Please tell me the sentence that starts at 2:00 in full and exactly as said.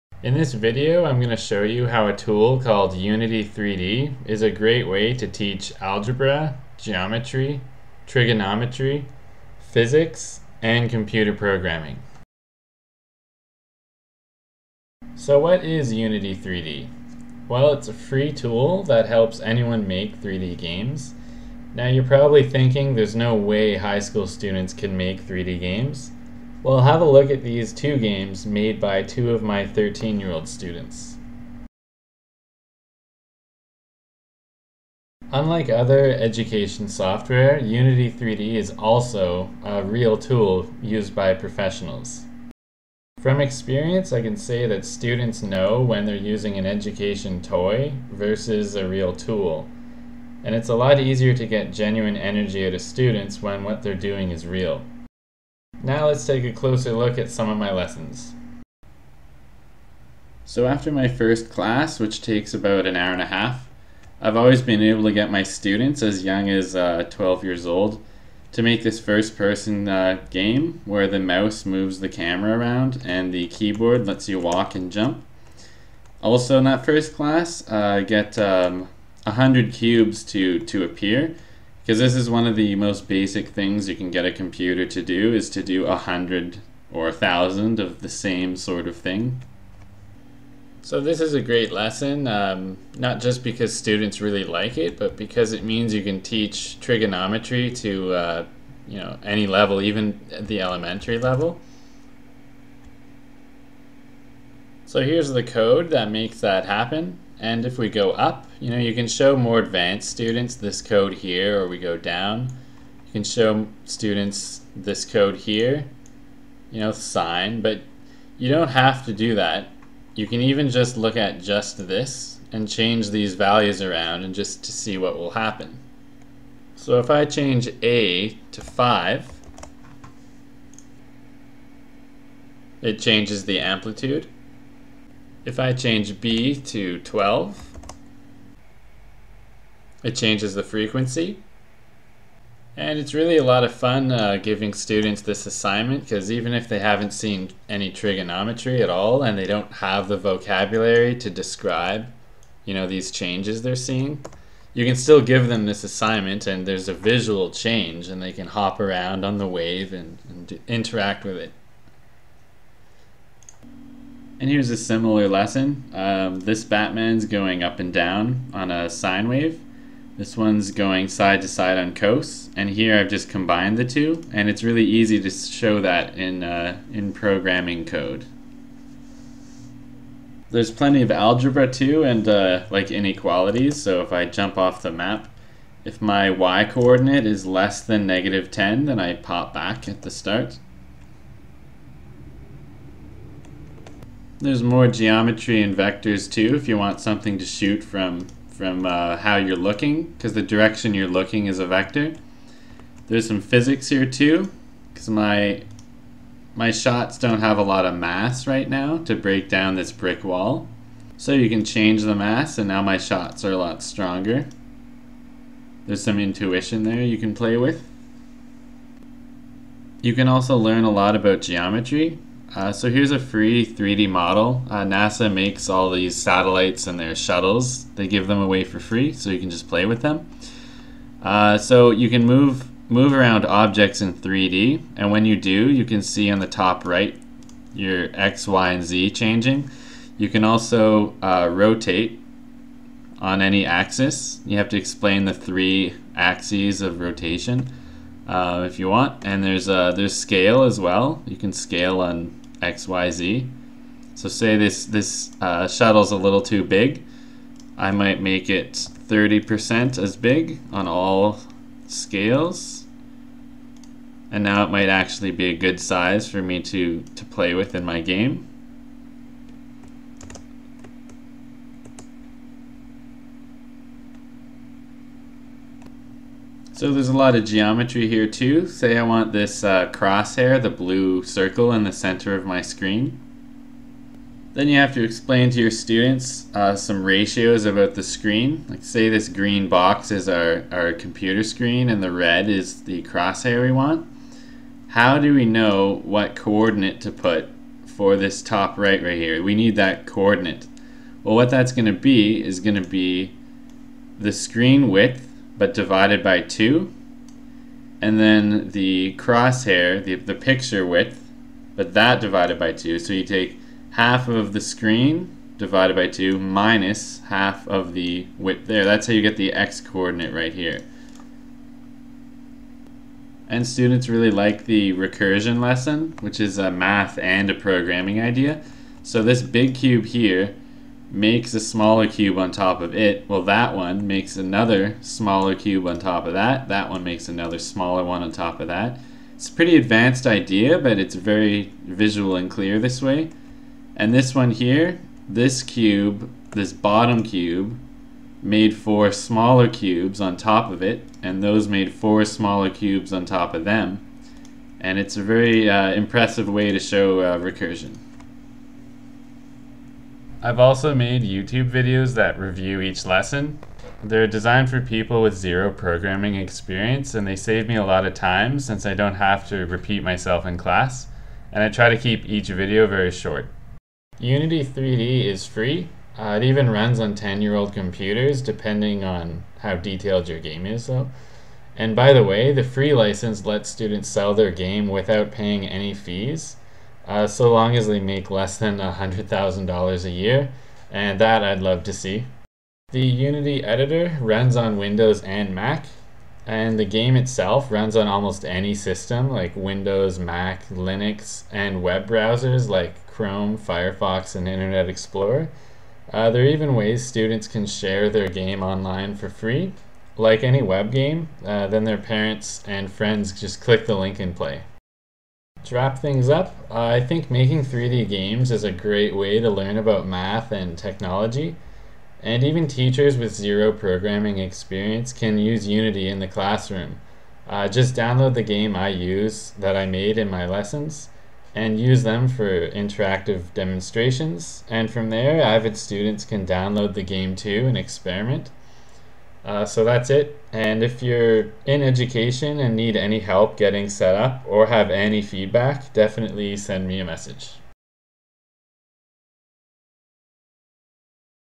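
You can even just look at just this and change these values around and just to see what will happen.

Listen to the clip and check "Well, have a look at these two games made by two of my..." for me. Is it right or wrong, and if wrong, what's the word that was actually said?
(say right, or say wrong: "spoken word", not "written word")
right.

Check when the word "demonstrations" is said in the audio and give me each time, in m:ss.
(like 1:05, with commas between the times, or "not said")
7:13.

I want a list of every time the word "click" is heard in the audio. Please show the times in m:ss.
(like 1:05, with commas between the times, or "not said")
6:53.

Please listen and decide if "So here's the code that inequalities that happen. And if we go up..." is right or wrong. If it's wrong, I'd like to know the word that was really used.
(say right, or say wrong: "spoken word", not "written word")
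wrong: "makes", not "inequalities".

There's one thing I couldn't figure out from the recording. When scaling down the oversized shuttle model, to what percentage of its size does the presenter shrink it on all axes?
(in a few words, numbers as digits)
30%.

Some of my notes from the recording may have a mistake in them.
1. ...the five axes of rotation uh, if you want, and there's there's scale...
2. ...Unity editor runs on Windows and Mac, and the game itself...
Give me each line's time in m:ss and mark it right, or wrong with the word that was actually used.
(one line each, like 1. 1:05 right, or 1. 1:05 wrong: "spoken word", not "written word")
1. 4:05 wrong: "three", not "five"
2. 6:33 right.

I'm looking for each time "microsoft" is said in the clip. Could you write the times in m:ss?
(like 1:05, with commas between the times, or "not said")
not said.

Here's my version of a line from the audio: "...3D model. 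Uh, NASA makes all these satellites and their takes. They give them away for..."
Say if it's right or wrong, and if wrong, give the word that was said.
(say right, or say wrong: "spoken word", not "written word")
wrong: "shuttles", not "takes".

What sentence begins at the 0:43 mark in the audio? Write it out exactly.
From experience, I can say that students know when they're using an education toy versus a real tool.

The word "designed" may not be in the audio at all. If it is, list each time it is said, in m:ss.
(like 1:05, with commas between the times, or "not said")
6:04.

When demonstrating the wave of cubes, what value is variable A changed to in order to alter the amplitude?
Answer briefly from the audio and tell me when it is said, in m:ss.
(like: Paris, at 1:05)
5, at 2:08.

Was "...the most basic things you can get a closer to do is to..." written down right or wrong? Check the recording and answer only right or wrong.
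wrong.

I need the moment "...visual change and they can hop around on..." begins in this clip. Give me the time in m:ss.
2:36.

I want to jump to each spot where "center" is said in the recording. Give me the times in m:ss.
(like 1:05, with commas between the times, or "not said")
4:41.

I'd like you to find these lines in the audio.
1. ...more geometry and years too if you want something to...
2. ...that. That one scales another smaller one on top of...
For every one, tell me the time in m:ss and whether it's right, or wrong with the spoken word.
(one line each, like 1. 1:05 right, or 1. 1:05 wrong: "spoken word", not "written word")
1. 3:14 wrong: "vectors", not "years"
2. 5:36 wrong: "makes", not "scales".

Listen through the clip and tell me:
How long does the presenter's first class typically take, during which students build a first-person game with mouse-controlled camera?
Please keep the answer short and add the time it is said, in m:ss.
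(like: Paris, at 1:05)
an hour and a half, at 1:02.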